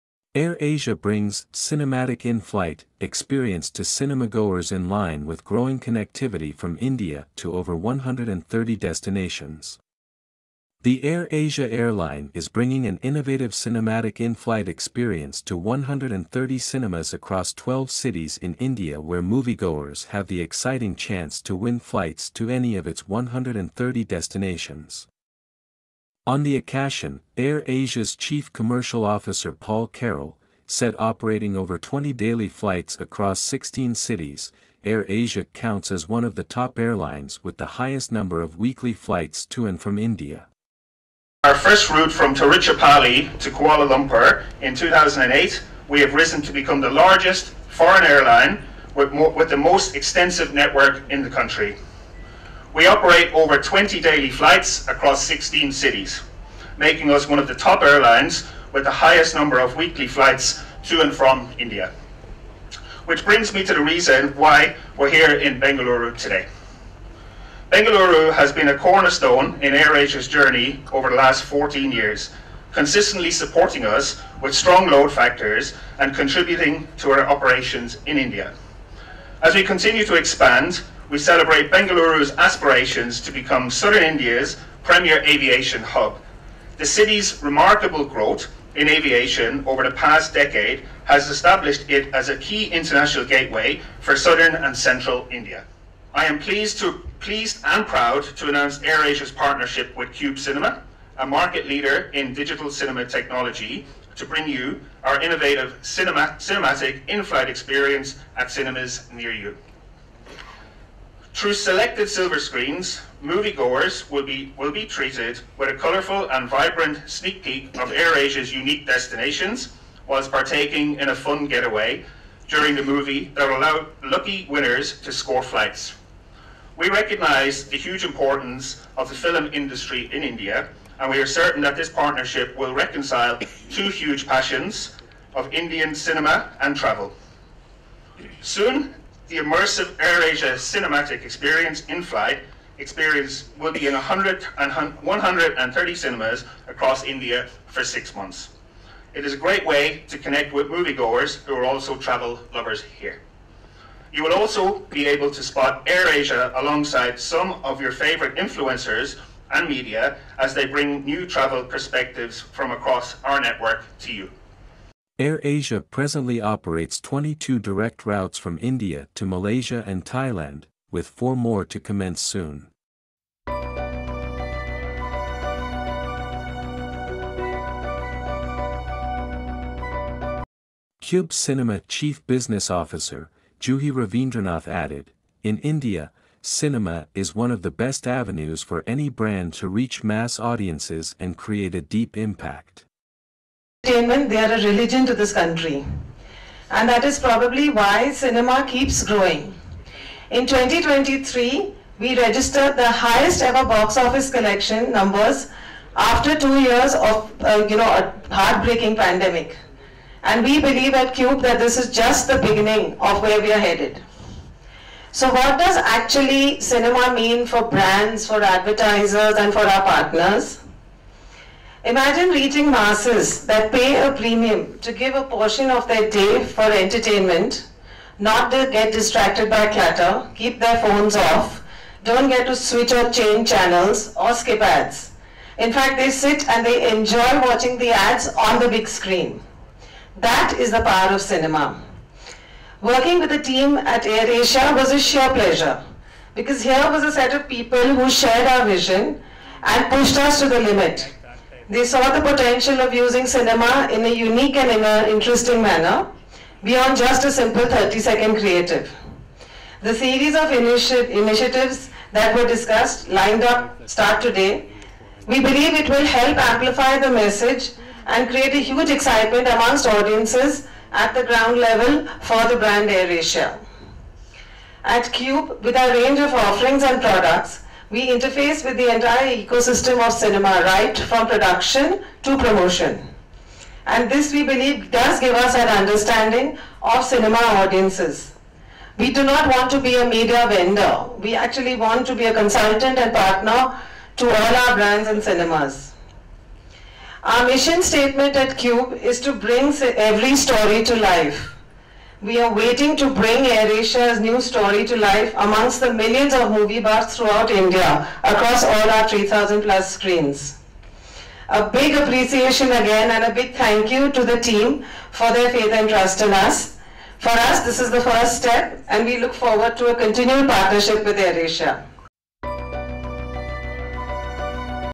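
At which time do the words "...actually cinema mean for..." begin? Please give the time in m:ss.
3:35.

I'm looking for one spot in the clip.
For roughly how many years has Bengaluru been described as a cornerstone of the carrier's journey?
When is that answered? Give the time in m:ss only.
1:11.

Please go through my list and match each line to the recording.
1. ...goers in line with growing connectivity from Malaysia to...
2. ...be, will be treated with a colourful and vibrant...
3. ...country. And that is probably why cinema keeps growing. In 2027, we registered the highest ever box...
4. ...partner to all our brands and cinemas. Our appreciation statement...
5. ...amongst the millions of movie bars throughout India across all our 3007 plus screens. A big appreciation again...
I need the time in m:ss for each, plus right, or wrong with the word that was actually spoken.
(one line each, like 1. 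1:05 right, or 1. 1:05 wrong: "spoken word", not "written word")
1. 0:04 wrong: "India", not "Malaysia"
2. 1:54 right
3. 3:15 wrong: "2023", not "2027"
4. 4:53 wrong: "mission", not "appreciation"
5. 5:05 wrong: "3000", not "3007".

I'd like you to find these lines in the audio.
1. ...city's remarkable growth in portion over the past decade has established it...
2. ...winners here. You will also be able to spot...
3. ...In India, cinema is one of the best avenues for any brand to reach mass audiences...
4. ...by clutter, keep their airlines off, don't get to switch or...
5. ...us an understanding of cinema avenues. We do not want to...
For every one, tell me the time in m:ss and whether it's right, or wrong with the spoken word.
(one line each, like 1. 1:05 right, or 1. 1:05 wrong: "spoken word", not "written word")
1. 1:26 wrong: "aviation", not "portion"
2. 2:32 wrong: "lovers", not "winners"
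3. 3:05 right
4. 3:49 wrong: "phones", not "airlines"
5. 4:45 wrong: "audiences", not "avenues".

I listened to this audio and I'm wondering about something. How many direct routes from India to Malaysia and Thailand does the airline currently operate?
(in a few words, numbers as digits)
22.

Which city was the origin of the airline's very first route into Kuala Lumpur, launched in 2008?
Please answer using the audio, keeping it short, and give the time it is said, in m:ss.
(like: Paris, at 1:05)
Tiruchirappalli, at 0:42.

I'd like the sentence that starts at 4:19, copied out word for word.
The series of initi initiatives that were discussed lined up start today.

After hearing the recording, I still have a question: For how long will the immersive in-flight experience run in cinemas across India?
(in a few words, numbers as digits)
6 months.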